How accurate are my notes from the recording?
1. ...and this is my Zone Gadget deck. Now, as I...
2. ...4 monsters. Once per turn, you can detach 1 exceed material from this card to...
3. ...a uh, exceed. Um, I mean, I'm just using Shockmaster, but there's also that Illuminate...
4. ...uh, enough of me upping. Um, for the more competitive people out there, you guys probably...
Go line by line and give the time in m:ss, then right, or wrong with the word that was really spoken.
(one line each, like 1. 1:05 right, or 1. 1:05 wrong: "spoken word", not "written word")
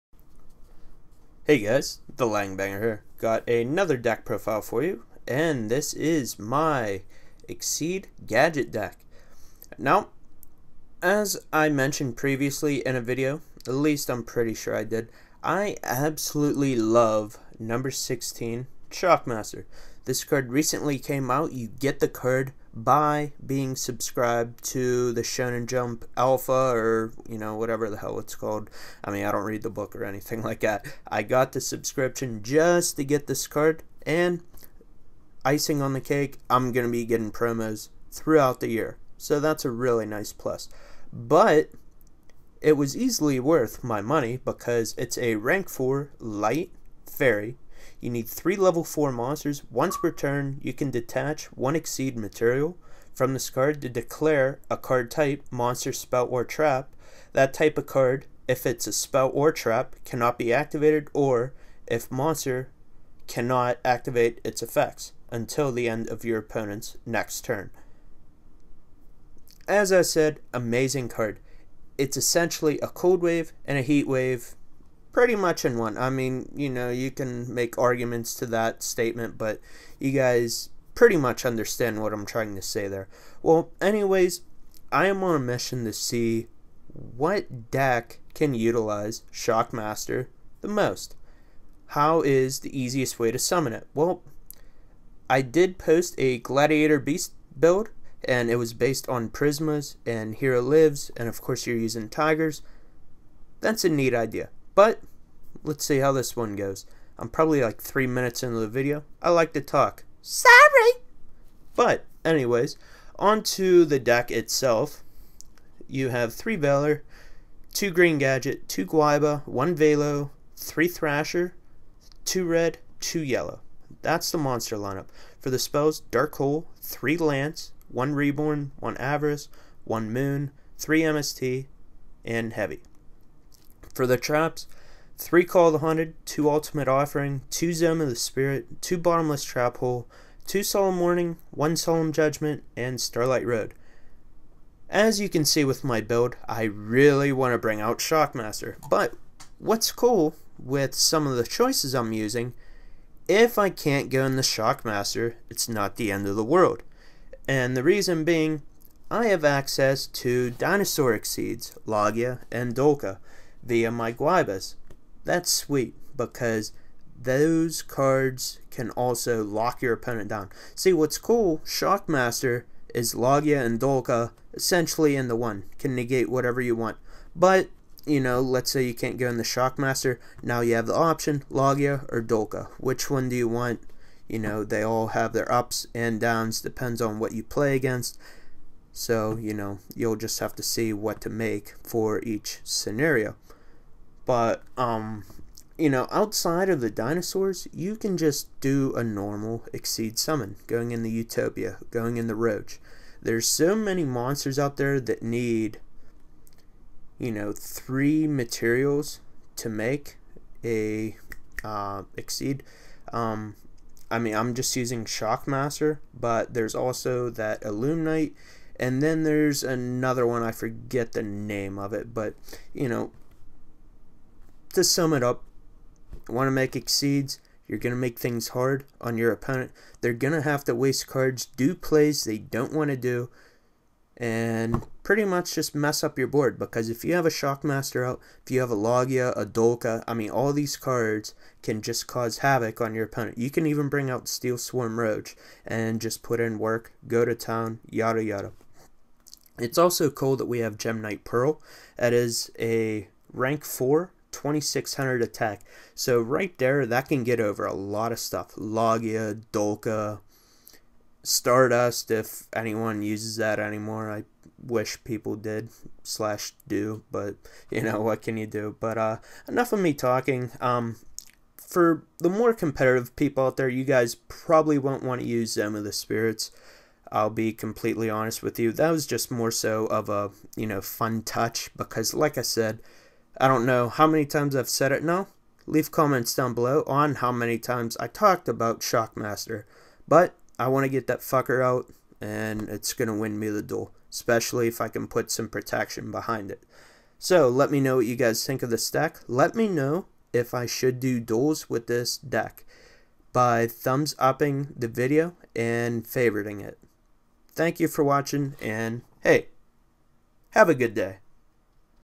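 1. 0:05 wrong: "Exceed", not "Zone"
2. 0:48 right
3. 3:30 right
4. 4:28 wrong: "talking", not "upping".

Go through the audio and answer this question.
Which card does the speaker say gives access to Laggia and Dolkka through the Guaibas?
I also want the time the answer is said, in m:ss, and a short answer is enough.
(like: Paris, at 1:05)
Dinosauric Seeds, at 2:40.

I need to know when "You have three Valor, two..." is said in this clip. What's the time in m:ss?
1:55.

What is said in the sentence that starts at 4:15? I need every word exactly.
So right there, that can get over a lot of stuff.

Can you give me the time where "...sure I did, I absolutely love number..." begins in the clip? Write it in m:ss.
0:14.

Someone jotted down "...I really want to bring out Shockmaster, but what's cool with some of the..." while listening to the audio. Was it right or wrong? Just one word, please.
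right.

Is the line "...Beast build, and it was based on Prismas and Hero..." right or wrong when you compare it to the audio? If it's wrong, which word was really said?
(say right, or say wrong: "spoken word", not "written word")
right.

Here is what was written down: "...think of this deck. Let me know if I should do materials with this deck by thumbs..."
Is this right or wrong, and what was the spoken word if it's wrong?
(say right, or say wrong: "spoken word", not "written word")
wrong: "duels", not "materials".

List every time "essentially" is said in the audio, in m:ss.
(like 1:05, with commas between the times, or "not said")
1:12, 2:54.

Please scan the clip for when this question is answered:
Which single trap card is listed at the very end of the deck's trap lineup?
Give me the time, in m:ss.
2:22.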